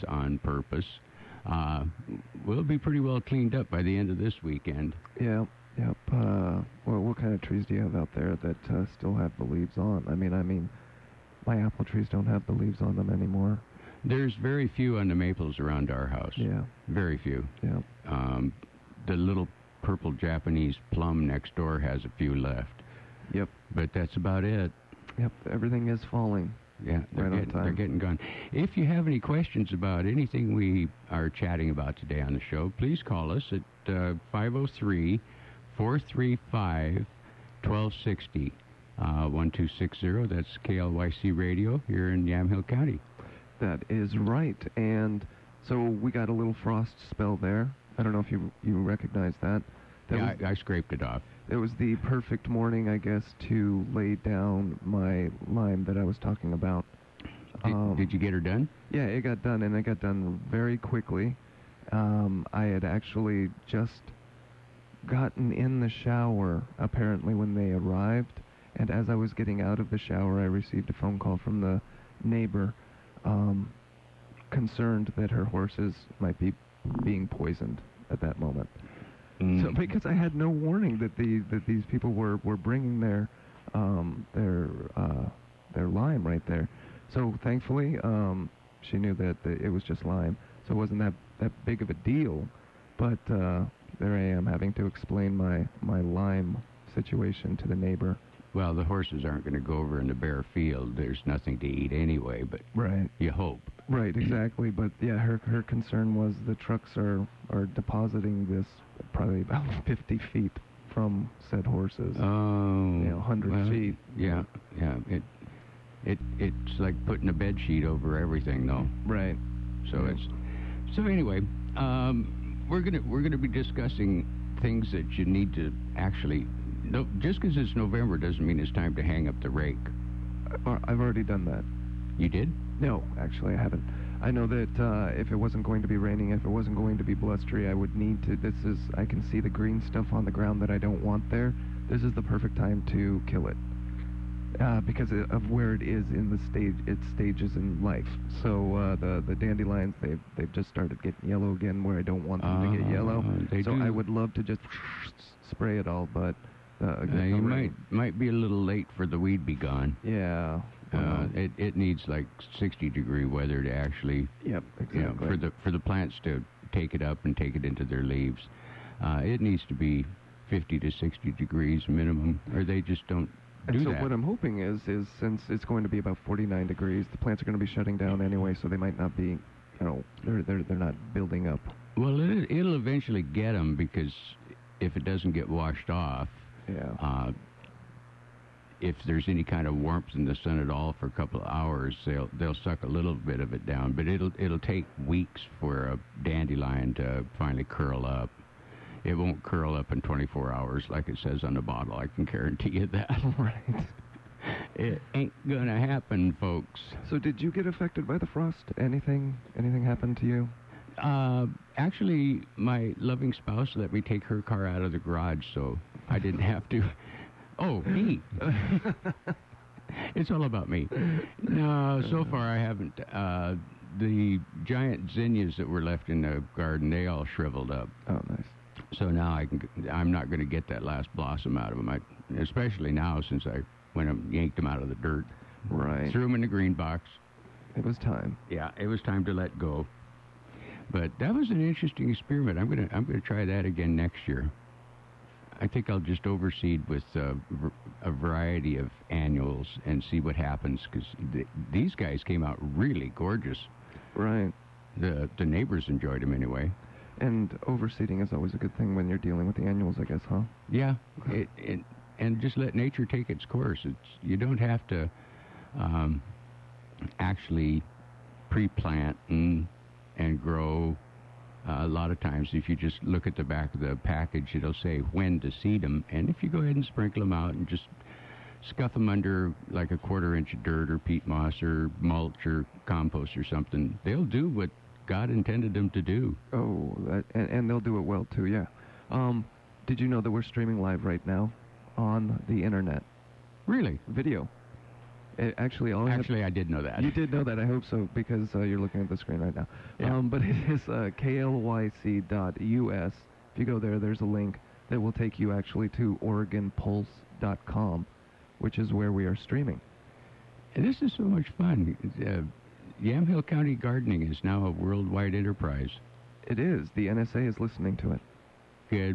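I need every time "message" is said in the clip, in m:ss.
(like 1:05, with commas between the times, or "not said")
not said.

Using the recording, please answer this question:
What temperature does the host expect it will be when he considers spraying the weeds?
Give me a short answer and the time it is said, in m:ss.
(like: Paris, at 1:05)
49 degrees, at 2:56.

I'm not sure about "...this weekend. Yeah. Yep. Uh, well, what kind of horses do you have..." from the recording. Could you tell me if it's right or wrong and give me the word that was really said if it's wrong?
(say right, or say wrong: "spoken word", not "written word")
wrong: "trees", not "horses".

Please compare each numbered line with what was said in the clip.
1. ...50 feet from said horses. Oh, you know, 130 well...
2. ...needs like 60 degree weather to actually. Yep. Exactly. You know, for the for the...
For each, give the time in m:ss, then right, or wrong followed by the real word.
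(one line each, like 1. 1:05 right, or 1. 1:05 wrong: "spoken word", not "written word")
1. 1:49 wrong: "100", not "130"
2. 2:41 right.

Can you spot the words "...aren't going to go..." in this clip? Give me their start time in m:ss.
1:39.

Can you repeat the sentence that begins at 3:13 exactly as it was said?
But it'll it'll take weeks for a dandelion to finally curl up.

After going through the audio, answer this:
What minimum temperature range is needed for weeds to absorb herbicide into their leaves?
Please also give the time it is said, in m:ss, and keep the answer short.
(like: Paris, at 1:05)
50 to 60 degrees, at 2:50.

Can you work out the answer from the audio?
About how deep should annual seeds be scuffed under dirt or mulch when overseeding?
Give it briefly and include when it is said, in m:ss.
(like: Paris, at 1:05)
A quarter inch, at 4:39.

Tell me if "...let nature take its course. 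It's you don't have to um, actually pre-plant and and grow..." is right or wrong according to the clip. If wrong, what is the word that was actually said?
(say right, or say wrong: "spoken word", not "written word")
right.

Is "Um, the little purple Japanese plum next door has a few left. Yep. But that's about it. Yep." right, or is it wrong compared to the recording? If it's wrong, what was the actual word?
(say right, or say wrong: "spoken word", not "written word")
right.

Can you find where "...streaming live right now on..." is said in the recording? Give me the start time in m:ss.
4:50.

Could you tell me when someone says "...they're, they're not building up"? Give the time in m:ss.
3:00.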